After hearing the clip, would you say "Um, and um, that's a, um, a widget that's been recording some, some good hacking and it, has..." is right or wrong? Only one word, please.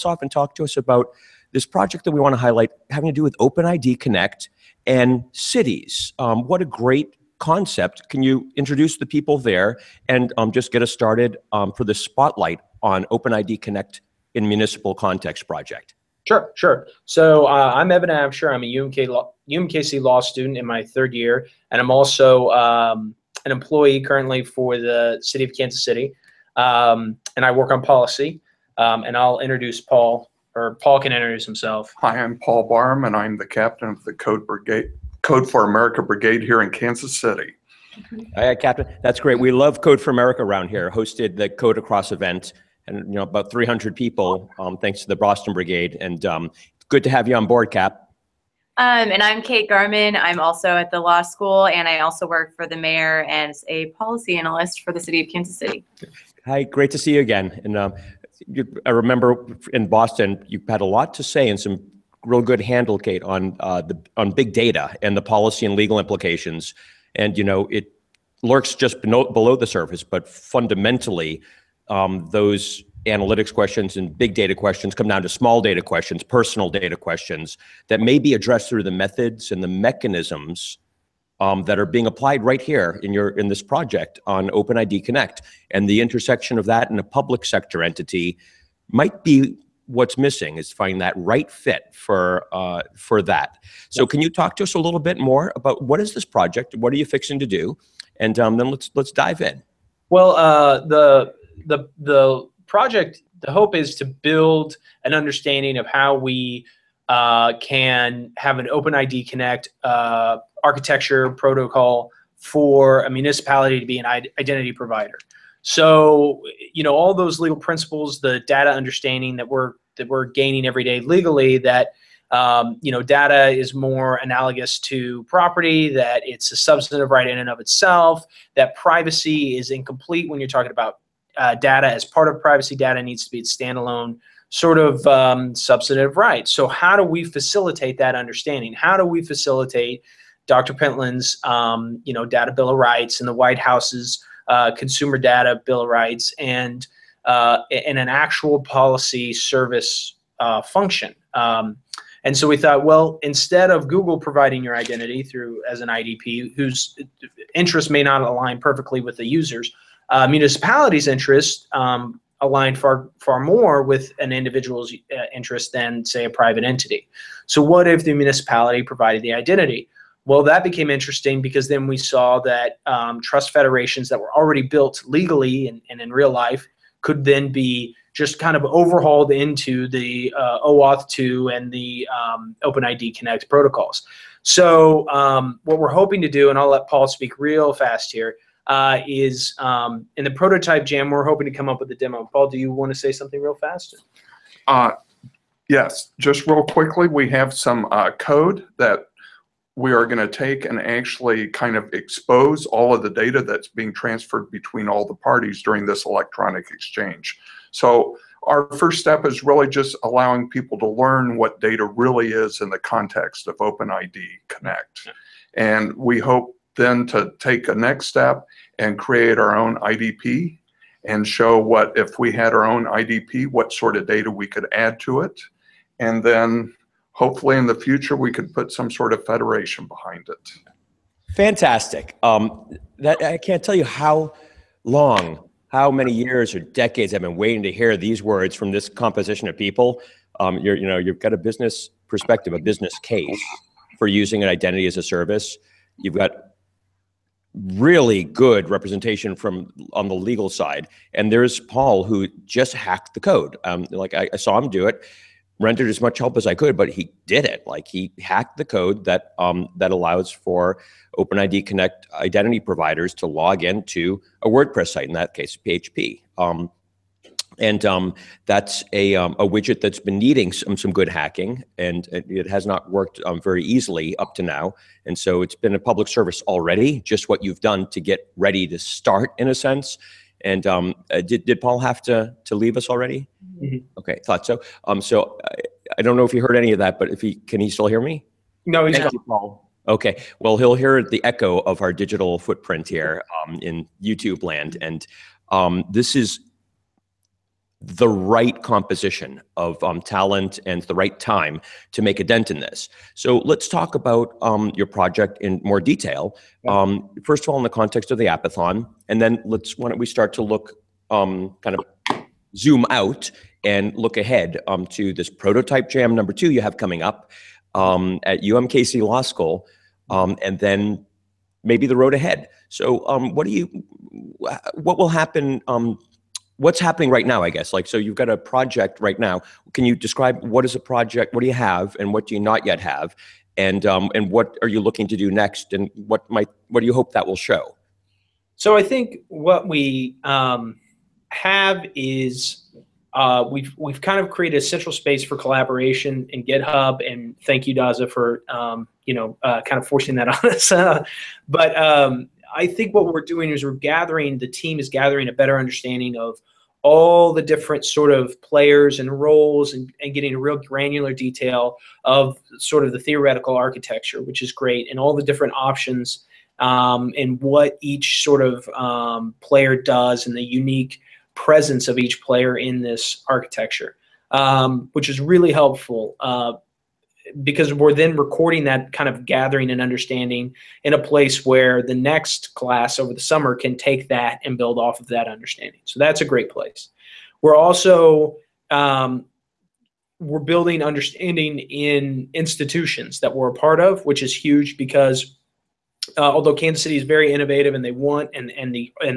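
wrong.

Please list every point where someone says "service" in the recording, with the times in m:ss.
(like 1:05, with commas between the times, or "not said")
2:29, 4:05, 4:36.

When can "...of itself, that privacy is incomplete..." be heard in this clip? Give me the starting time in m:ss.
2:07.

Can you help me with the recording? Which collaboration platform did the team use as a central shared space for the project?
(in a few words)
GitHub.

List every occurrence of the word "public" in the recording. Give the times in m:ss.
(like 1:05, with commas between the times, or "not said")
1:27, 4:35.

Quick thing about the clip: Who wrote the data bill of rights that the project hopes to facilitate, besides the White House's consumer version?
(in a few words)
Dr. Pentland.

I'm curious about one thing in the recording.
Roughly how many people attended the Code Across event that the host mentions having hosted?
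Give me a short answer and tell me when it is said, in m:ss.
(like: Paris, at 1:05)
300, at 0:43.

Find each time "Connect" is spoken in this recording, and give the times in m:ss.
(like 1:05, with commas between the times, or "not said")
0:03, 0:13, 1:25, 1:49, 3:03, 3:34, 4:21.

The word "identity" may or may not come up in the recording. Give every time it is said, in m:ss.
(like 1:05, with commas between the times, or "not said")
1:54, 2:34, 2:49, 4:04, 4:22.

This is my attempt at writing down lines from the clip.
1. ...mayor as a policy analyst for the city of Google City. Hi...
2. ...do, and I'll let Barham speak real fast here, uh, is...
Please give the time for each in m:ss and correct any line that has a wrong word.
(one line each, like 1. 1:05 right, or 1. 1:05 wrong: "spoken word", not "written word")
1. 0:52 wrong: "Kansas", not "Google"
2. 3:06 wrong: "Paul", not "Barham".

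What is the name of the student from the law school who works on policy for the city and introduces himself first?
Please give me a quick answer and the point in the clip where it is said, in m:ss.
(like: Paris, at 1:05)
Evan Absher, at 0:17.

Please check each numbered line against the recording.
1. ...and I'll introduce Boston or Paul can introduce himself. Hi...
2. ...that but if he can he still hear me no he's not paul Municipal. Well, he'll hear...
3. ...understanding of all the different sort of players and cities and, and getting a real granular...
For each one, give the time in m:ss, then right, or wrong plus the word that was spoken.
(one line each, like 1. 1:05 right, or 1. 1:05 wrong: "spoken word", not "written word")
1. 0:29 wrong: "Paul", not "Boston"
2. 4:46 wrong: "Okay", not "Municipal"
3. 5:55 wrong: "roles", not "cities".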